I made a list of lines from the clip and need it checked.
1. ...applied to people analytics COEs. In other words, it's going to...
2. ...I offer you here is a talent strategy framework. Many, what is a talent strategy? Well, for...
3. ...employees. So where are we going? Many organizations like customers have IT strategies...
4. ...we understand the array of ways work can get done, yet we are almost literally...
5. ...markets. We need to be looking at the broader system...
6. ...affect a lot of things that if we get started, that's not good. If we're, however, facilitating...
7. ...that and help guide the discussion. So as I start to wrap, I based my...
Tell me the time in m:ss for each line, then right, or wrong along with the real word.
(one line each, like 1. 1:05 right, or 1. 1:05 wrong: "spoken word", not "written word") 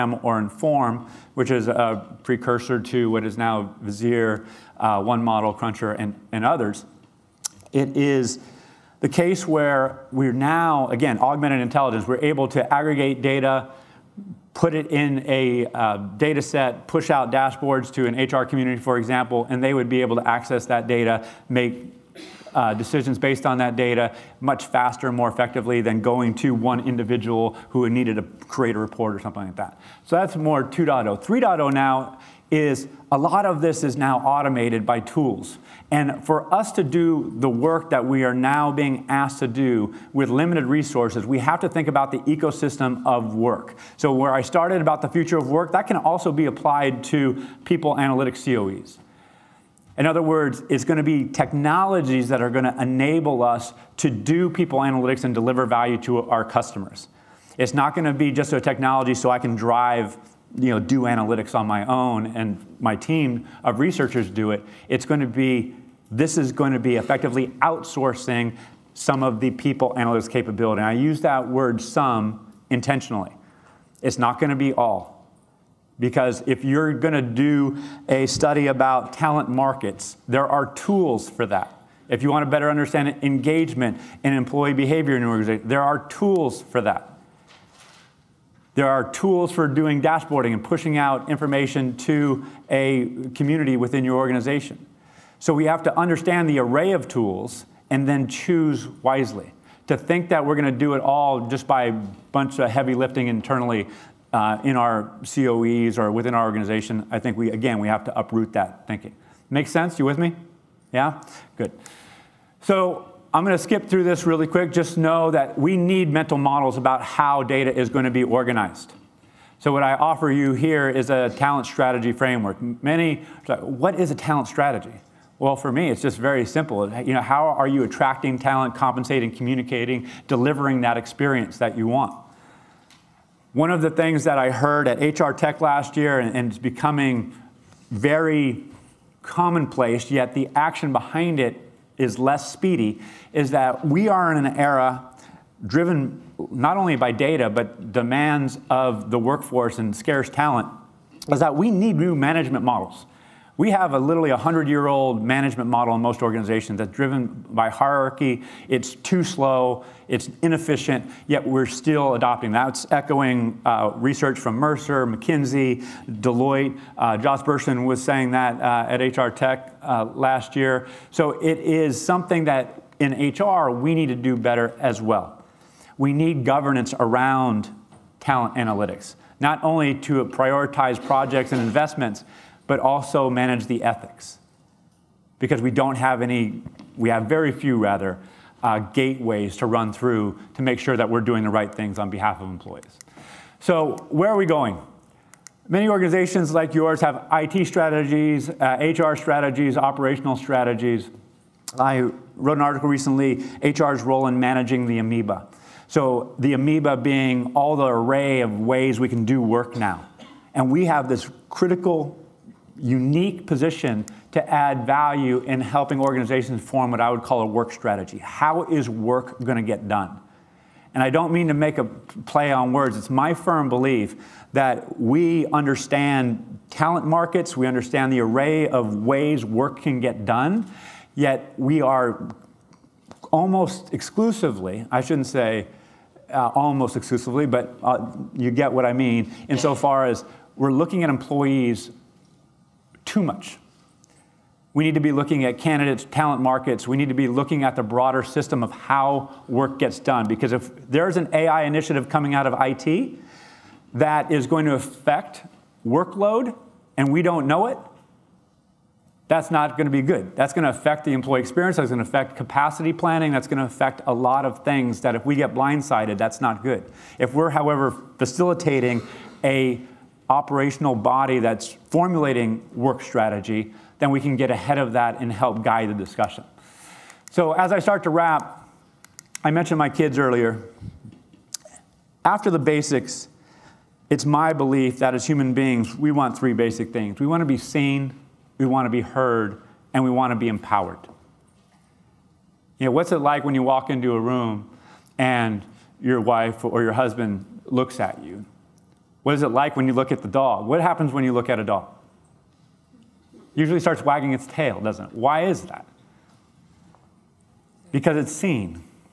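1. 0:46 right
2. 1:59 right
3. 3:12 wrong: "yours", not "customers"
4. 3:47 wrong: "exclusively", not "literally"
5. 4:06 right
6. 4:23 wrong: "blindsided", not "started"
7. 4:34 wrong: "mentioned", not "based".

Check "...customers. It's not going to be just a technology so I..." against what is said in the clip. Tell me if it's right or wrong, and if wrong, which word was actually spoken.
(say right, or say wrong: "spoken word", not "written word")
right.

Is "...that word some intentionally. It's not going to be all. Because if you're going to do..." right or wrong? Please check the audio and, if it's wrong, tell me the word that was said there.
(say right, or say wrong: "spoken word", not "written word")
right.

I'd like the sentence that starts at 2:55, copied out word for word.
We need governance around talent analytics, not only to prioritize projects and investments but also manage the ethics.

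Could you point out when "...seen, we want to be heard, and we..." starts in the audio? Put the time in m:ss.
4:47.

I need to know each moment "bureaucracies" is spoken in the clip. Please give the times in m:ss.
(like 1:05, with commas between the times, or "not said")
not said.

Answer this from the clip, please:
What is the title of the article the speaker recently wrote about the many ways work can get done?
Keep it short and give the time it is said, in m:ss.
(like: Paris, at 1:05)
HR's role in managing the amoeba, at 3:23.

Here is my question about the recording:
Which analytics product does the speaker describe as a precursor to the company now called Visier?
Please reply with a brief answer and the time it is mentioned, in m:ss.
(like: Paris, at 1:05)
Inform, at 0:00.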